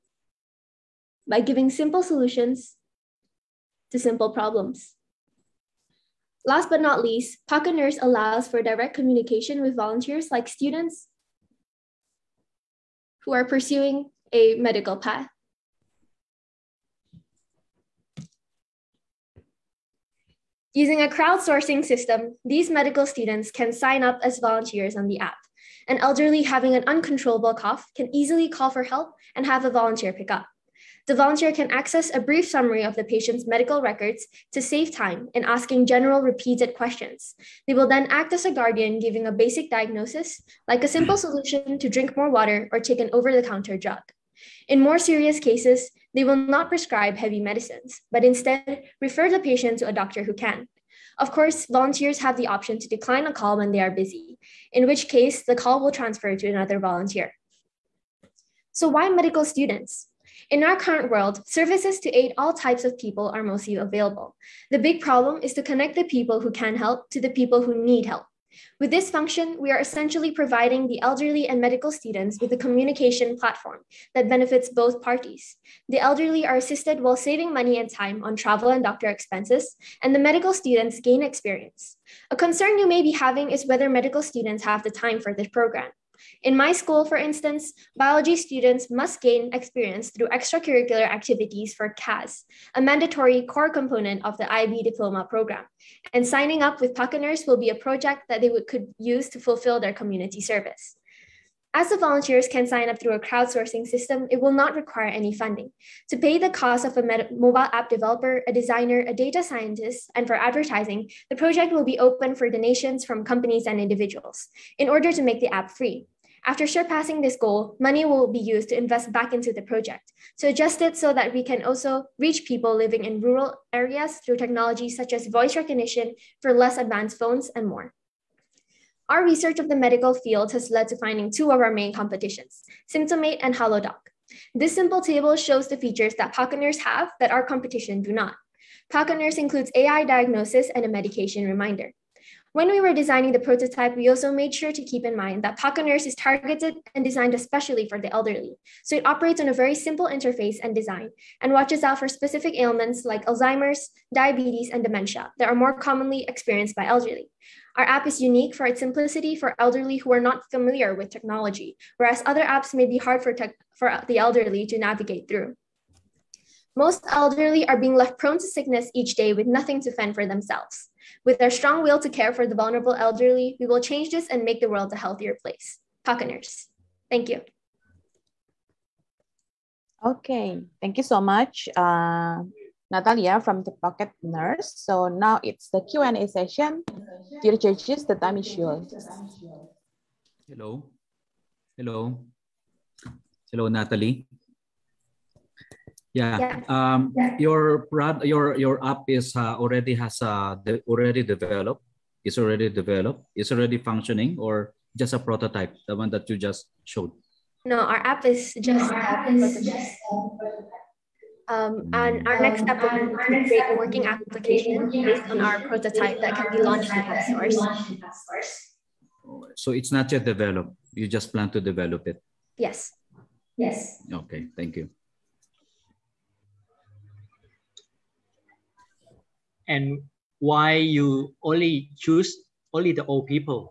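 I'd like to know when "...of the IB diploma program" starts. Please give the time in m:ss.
1:34.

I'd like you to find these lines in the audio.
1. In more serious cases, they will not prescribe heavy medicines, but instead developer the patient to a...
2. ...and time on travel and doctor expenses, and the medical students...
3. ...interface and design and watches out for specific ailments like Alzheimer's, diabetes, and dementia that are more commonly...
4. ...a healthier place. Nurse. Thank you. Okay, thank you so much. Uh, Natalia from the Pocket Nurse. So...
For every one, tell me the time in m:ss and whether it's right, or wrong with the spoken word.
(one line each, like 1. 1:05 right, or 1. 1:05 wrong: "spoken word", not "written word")
1. 0:44 wrong: "refer", not "developer"
2. 1:17 right
3. 2:30 right
4. 2:54 right.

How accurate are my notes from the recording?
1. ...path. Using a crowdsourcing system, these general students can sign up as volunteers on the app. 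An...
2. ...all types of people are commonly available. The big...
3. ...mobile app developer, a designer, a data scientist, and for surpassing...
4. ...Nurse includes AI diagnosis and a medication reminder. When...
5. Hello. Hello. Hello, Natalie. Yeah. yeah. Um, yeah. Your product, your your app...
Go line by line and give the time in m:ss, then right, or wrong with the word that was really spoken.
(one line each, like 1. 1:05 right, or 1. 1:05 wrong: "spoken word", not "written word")
1. 0:14 wrong: "medical", not "general"
2. 1:02 wrong: "mostly", not "commonly"
3. 1:47 wrong: "advertising", not "surpassing"
4. 2:19 right
5. 3:10 right.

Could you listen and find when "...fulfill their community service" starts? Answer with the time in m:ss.
1:39.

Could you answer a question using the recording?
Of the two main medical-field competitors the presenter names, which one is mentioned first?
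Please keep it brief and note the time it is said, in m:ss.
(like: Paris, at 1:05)
Symptomate, at 2:12.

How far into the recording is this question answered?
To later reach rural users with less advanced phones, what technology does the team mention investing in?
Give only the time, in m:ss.
2:05.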